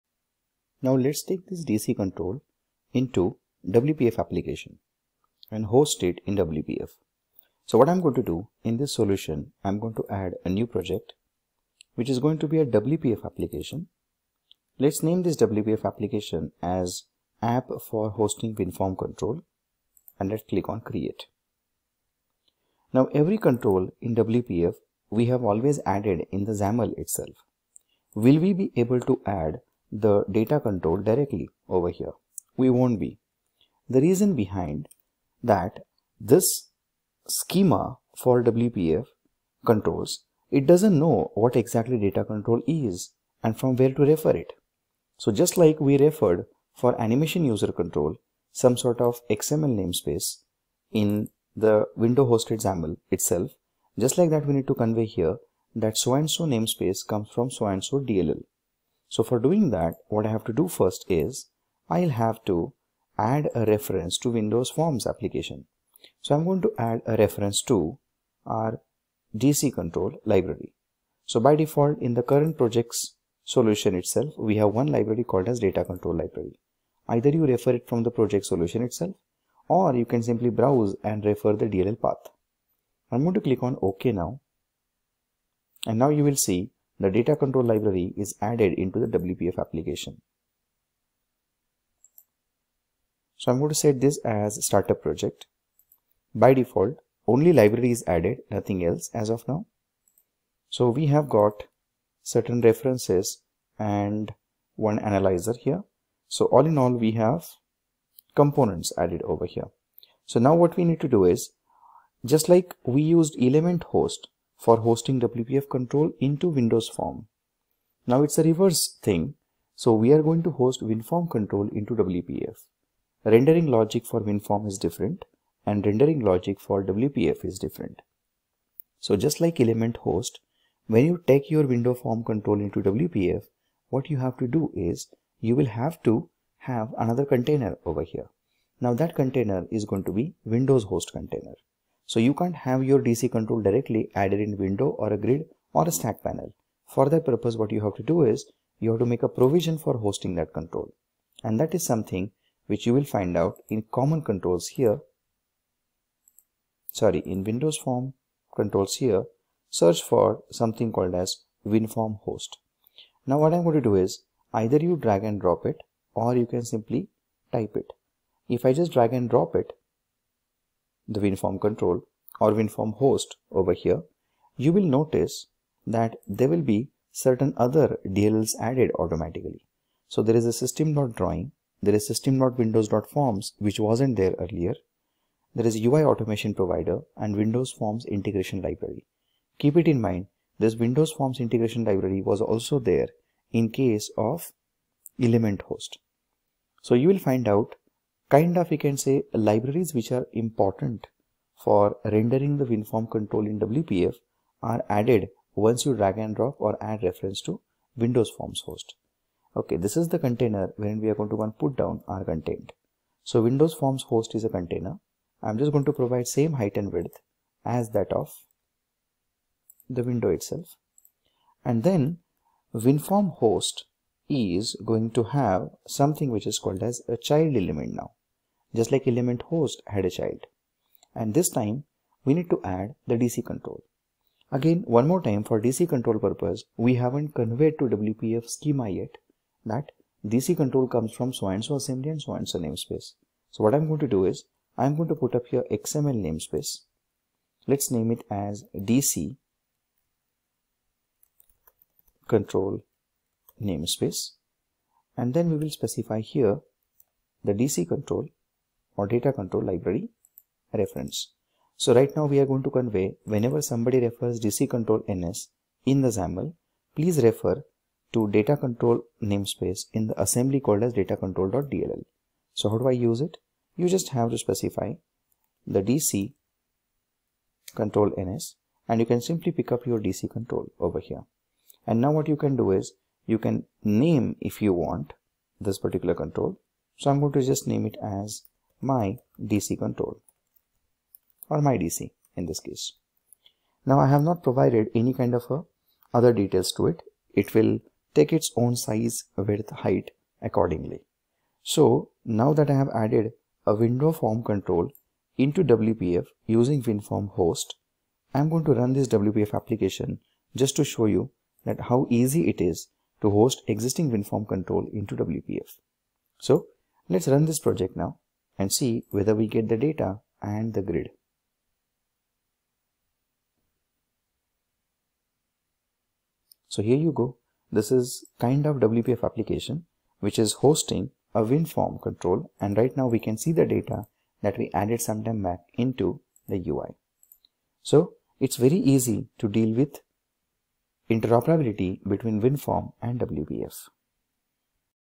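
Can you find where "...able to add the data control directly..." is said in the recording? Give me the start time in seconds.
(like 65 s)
28 s.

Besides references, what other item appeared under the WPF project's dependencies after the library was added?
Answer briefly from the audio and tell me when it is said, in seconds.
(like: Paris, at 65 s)
analyzer, at 104 s.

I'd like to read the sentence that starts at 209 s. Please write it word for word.
Okay, this is the container wherein we are going to put down our content.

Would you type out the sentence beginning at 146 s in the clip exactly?
For that purpose, what you have to do is you have to make a provision for hosting that control.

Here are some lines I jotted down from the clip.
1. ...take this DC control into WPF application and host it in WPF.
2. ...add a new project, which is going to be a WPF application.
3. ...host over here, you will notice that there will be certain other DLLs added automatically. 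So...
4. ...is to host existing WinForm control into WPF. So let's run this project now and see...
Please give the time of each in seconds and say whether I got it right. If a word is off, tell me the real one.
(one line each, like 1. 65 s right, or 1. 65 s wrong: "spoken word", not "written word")
1. 1 s right
2. 10 s right
3. 172 s right
4. 312 s right.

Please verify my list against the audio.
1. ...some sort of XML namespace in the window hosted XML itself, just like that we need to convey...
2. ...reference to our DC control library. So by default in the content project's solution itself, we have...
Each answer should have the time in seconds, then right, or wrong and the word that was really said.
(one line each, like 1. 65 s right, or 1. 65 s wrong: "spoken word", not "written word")
1. 48 s wrong: "XAML", not "XML"
2. 67 s wrong: "current", not "content".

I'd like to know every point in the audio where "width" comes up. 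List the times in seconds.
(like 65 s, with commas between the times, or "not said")
216 s, 299 s.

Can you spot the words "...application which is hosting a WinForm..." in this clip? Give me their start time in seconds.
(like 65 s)
329 s.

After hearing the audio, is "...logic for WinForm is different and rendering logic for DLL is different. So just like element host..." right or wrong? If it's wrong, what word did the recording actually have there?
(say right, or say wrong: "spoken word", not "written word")
wrong: "WPF", not "DLL".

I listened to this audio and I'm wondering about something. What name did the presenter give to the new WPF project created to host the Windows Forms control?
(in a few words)
app for hosting WinForm control.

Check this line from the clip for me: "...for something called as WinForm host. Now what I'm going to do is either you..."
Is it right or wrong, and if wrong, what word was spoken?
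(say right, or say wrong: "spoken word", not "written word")
right.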